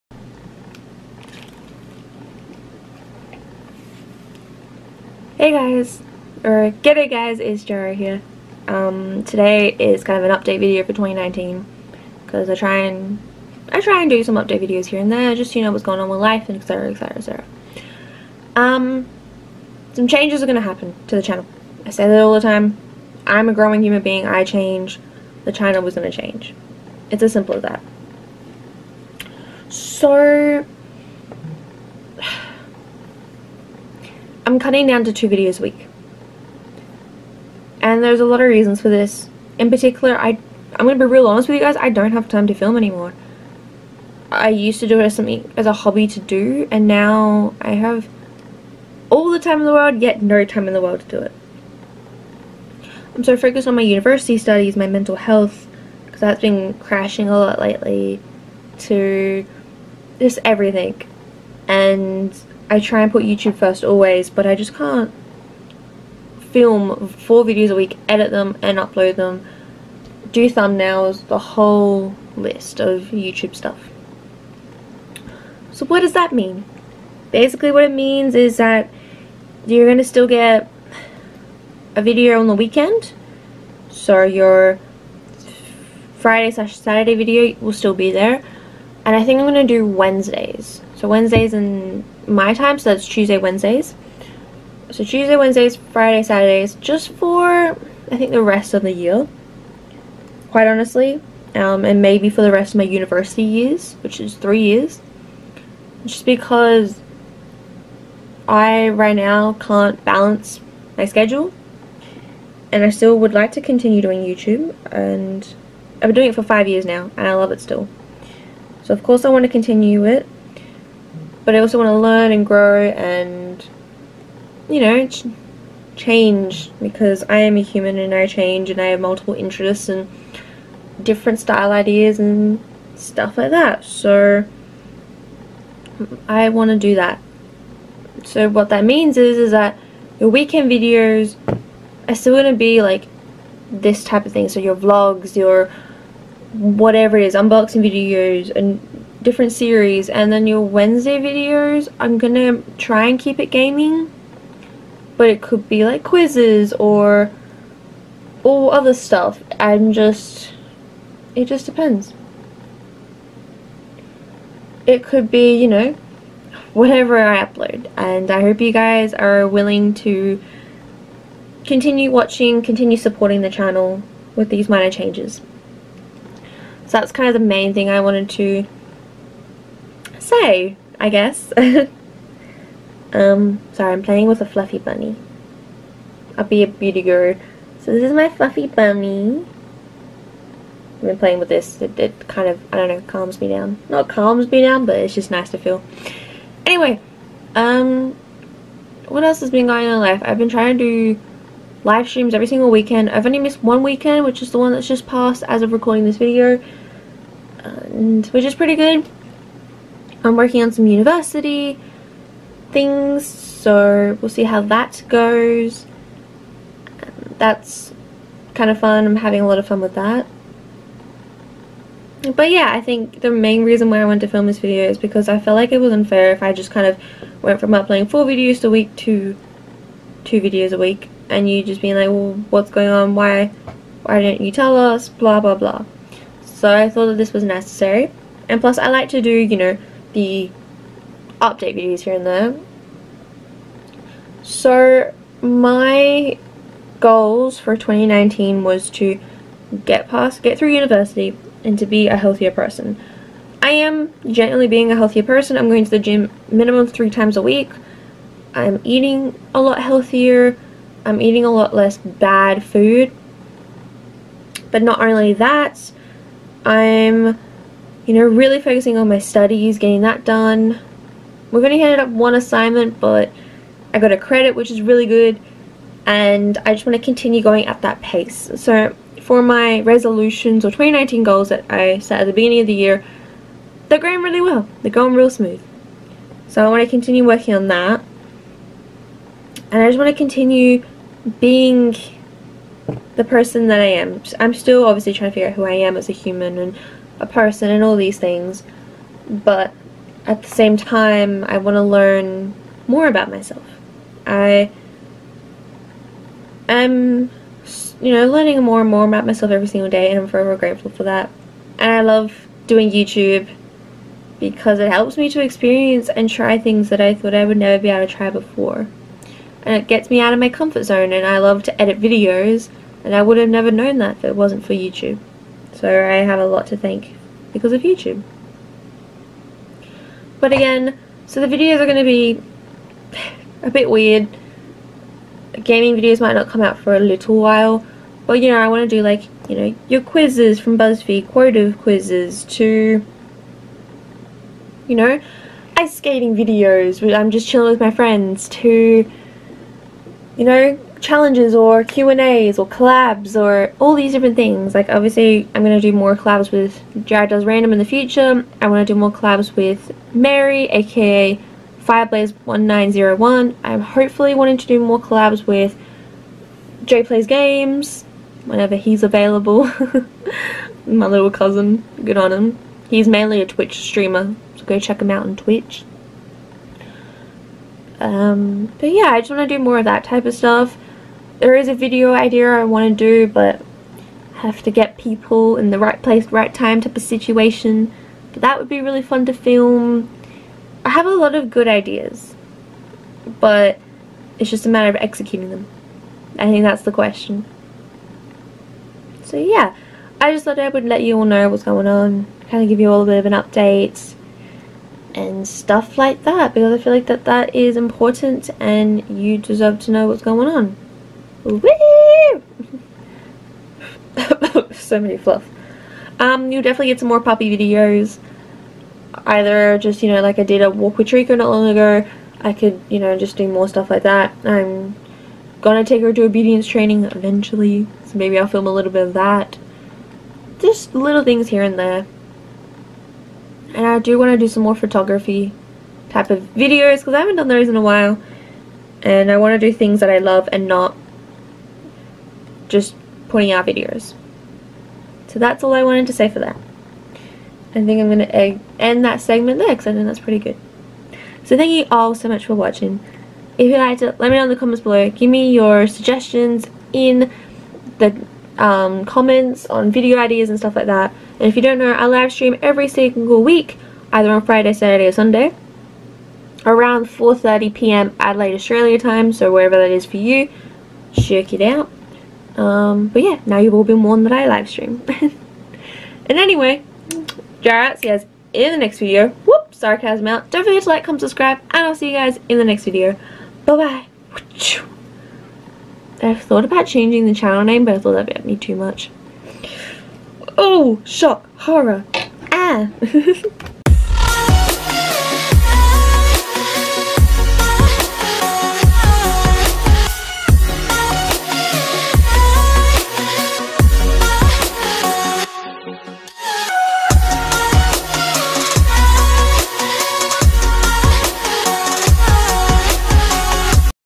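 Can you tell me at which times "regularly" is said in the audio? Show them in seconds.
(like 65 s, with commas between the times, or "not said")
not said.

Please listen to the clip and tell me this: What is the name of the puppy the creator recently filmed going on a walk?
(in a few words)
Trico.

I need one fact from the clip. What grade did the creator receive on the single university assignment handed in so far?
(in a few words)
credit.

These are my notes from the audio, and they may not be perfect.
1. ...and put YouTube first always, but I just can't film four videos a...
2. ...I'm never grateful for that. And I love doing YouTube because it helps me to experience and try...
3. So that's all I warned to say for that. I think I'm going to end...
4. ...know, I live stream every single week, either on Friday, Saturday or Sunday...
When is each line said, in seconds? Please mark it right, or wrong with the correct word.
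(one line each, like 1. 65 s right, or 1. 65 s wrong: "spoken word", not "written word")
1. 63 s right
2. 310 s wrong: "forever", not "never"
3. 445 s wrong: "wanted", not "warned"
4. 461 s right.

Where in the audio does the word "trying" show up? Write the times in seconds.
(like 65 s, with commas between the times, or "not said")
200 s, 295 s.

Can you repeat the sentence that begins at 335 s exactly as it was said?
Gaming videos might not come out for a little while.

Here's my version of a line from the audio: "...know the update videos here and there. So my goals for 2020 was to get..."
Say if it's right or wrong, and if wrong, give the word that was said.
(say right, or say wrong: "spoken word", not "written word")
wrong: "2019", not "2020".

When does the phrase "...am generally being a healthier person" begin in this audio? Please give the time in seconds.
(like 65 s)
253 s.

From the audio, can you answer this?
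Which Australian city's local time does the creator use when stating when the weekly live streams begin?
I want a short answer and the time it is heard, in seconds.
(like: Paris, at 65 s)
Adelaide, at 468 s.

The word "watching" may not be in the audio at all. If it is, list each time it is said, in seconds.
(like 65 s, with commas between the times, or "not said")
172 s, 452 s.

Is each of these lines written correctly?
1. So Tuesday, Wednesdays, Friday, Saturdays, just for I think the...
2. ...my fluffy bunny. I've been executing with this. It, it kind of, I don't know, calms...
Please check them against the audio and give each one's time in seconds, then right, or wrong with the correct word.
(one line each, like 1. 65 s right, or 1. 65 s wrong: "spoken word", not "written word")
1. 94 s right
2. 188 s wrong: "playing", not "executing".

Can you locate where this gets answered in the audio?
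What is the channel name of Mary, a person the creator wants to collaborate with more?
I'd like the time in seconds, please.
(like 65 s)
361 s.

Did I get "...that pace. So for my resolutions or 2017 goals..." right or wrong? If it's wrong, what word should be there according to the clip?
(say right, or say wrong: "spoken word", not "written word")
wrong: "2019", not "2017".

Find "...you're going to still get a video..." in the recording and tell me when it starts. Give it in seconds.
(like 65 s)
79 s.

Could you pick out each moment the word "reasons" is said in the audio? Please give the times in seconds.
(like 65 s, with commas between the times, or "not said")
38 s, 223 s.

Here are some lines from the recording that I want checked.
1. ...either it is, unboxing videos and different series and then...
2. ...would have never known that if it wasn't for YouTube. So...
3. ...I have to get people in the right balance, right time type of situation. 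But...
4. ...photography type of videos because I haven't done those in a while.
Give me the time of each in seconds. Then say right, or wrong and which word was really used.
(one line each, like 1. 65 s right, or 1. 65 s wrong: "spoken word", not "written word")
1. 146 s wrong: "whatever", not "either"
2. 323 s right
3. 384 s wrong: "place", not "balance"
4. 434 s right.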